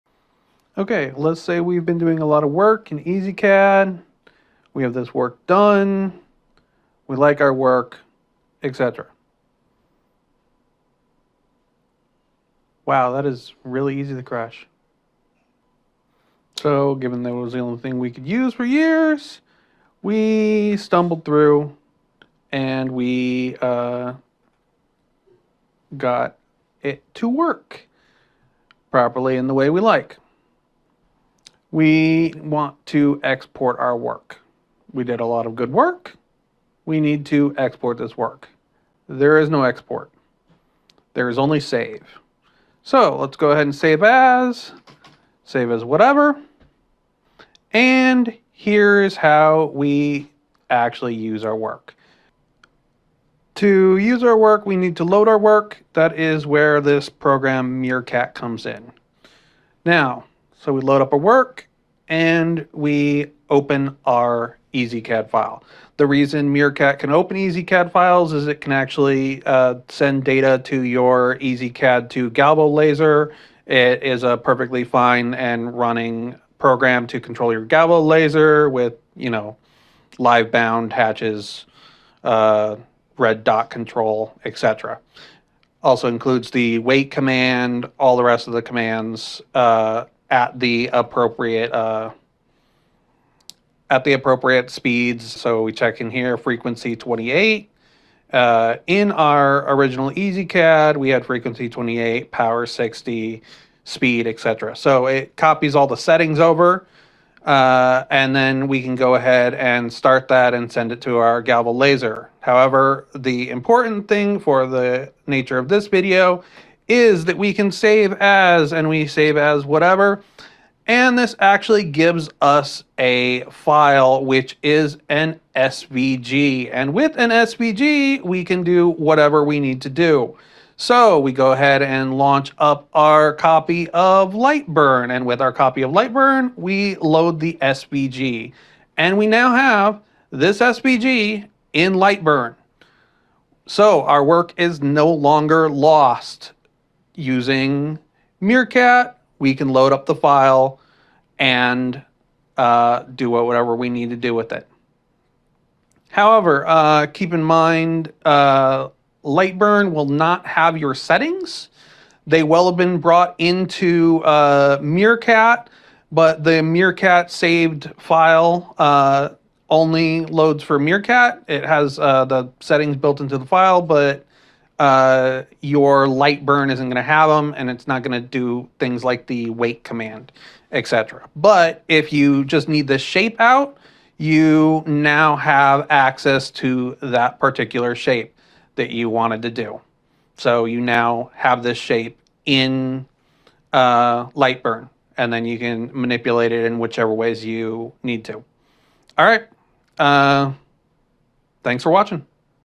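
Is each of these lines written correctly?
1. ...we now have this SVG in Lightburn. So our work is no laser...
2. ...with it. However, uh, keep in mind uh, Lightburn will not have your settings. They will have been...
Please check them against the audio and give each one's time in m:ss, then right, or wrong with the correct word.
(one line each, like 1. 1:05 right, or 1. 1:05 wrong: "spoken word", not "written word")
1. 2:19 wrong: "longer", not "laser"
2. 2:34 right.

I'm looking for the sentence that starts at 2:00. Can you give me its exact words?
And this actually gives us a file, which is an SVG.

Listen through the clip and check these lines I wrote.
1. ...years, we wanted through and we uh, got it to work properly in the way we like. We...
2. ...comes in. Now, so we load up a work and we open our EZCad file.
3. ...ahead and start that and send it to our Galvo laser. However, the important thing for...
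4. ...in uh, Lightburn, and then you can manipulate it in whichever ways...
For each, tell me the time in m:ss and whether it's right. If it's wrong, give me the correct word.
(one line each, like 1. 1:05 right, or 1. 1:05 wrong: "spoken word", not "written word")
1. 0:18 wrong: "stumbled", not "wanted"
2. 0:58 right
3. 1:49 right
4. 3:12 right.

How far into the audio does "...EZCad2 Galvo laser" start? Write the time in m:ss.
1:11.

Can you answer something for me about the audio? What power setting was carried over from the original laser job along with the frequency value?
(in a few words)
60.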